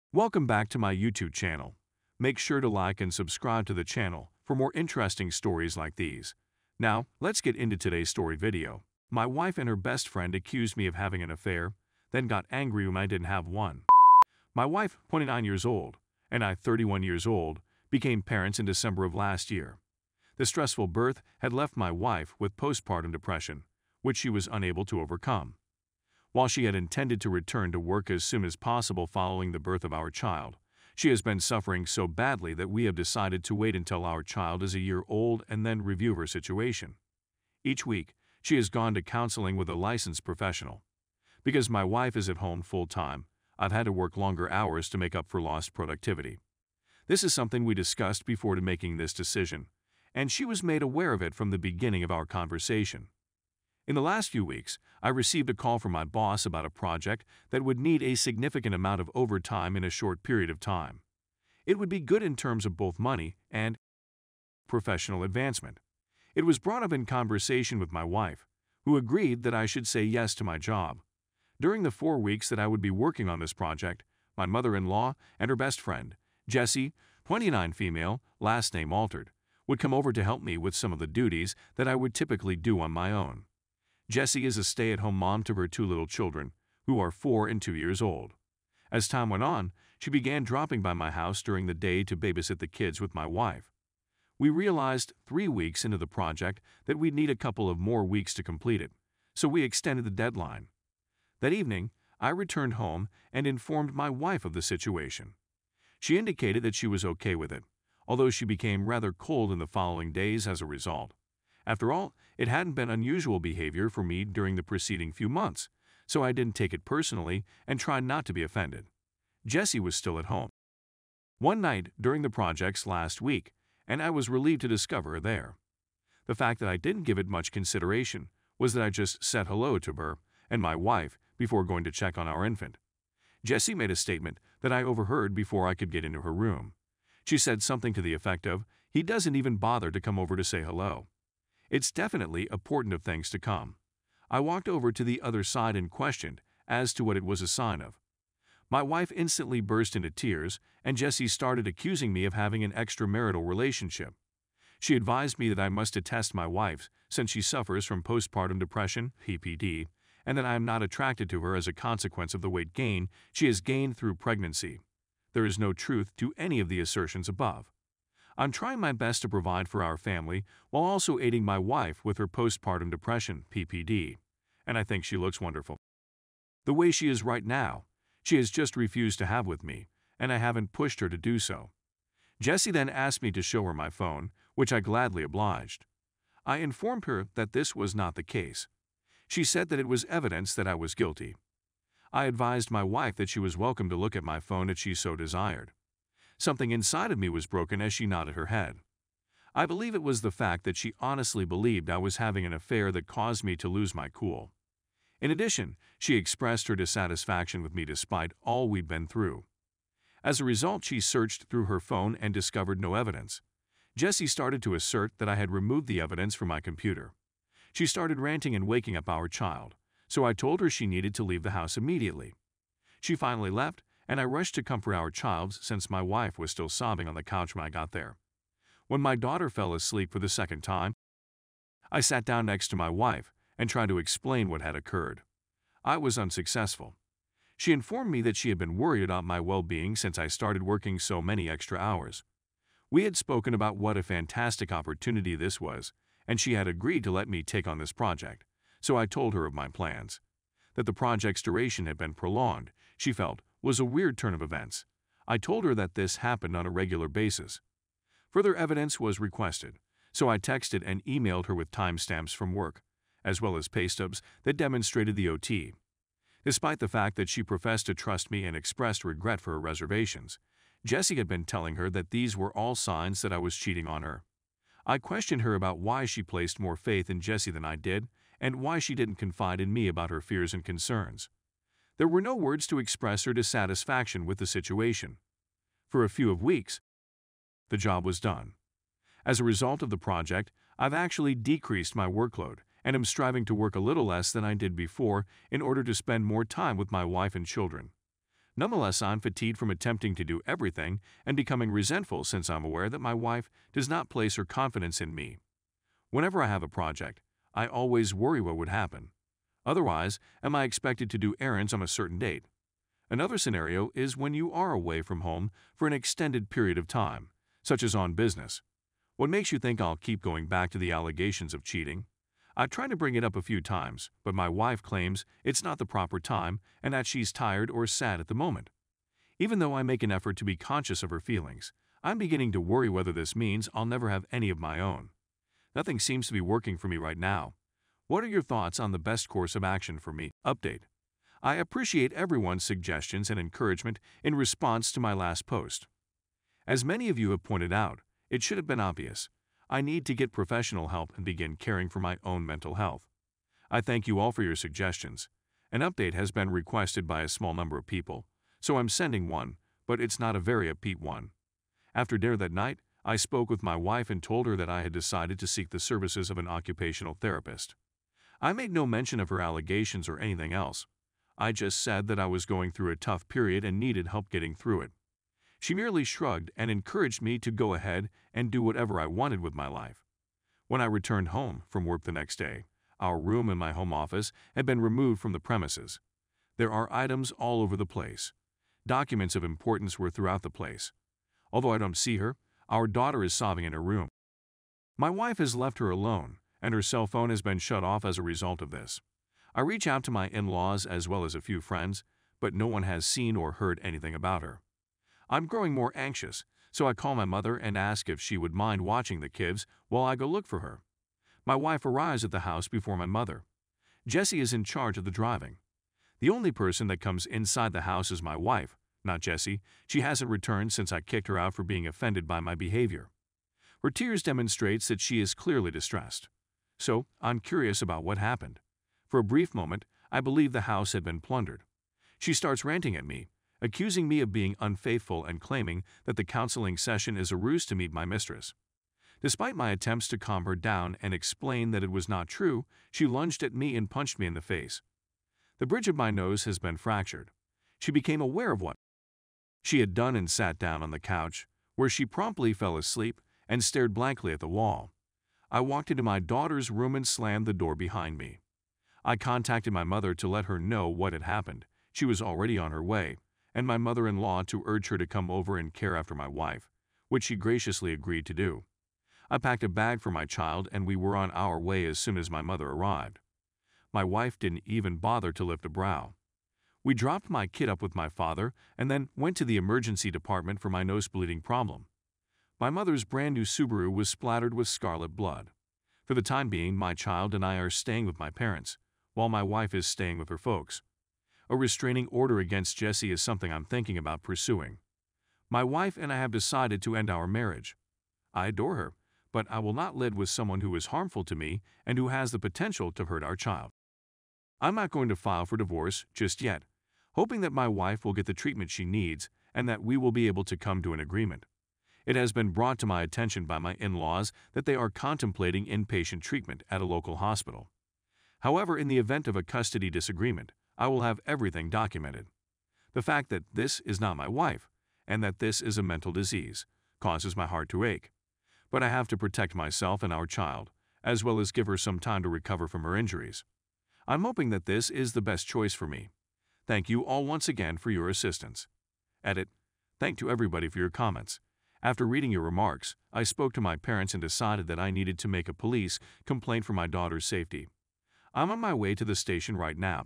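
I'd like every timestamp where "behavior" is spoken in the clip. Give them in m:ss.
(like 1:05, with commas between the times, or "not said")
1:53, 7:02.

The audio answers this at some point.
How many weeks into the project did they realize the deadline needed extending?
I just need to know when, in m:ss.
1:35.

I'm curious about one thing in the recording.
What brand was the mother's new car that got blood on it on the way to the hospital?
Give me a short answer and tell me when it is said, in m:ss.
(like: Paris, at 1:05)
Subaru, at 8:03.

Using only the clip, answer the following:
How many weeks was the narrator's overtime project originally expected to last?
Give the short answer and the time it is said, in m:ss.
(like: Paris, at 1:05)
4, at 1:11.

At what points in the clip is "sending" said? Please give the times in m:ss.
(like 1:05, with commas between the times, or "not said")
5:58.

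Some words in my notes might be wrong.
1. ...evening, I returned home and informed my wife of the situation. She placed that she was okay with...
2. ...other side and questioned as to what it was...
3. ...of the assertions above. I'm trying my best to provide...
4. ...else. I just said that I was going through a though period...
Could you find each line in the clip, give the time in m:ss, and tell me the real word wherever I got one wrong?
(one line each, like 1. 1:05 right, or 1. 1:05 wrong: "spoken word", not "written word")
1. 1:41 wrong: "indicated", not "placed"
2. 2:25 right
3. 2:46 right
4. 6:10 wrong: "tough", not "though".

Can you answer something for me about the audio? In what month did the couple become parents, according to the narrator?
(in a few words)
December.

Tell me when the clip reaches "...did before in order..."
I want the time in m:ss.
4:54.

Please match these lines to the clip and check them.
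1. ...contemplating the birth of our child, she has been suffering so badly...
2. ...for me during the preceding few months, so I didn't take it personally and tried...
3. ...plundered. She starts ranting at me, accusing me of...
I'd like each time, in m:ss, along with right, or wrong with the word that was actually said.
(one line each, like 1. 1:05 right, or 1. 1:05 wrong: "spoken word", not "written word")
1. 0:29 wrong: "following", not "contemplating"
2. 1:53 right
3. 7:11 right.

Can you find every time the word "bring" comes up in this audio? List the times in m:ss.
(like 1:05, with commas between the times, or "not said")
5:22.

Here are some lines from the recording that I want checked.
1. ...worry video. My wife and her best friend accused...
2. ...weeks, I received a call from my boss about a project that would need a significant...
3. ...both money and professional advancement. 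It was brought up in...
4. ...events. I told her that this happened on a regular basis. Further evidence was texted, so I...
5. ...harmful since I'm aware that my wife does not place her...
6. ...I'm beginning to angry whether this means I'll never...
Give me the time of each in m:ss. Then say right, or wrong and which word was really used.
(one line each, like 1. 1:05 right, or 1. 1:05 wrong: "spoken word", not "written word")
1. 0:08 wrong: "story", not "worry"
2. 0:54 right
3. 1:02 right
4. 4:14 wrong: "requested", not "texted"
5. 5:01 wrong: "resentful", not "harmful"
6. 5:32 wrong: "worry", not "angry".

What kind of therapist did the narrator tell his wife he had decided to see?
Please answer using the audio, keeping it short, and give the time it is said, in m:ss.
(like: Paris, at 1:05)
Occupational therapist, at 6:06.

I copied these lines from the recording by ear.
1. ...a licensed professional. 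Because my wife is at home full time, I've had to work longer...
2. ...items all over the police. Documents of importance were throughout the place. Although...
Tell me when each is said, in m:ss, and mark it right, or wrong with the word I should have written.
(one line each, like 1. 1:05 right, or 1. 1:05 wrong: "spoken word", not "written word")
1. 0:39 right
2. 6:26 wrong: "place", not "police".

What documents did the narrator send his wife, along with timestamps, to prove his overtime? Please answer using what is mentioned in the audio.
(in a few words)
Pay stubs.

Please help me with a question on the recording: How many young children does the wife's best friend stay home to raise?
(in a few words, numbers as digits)
2.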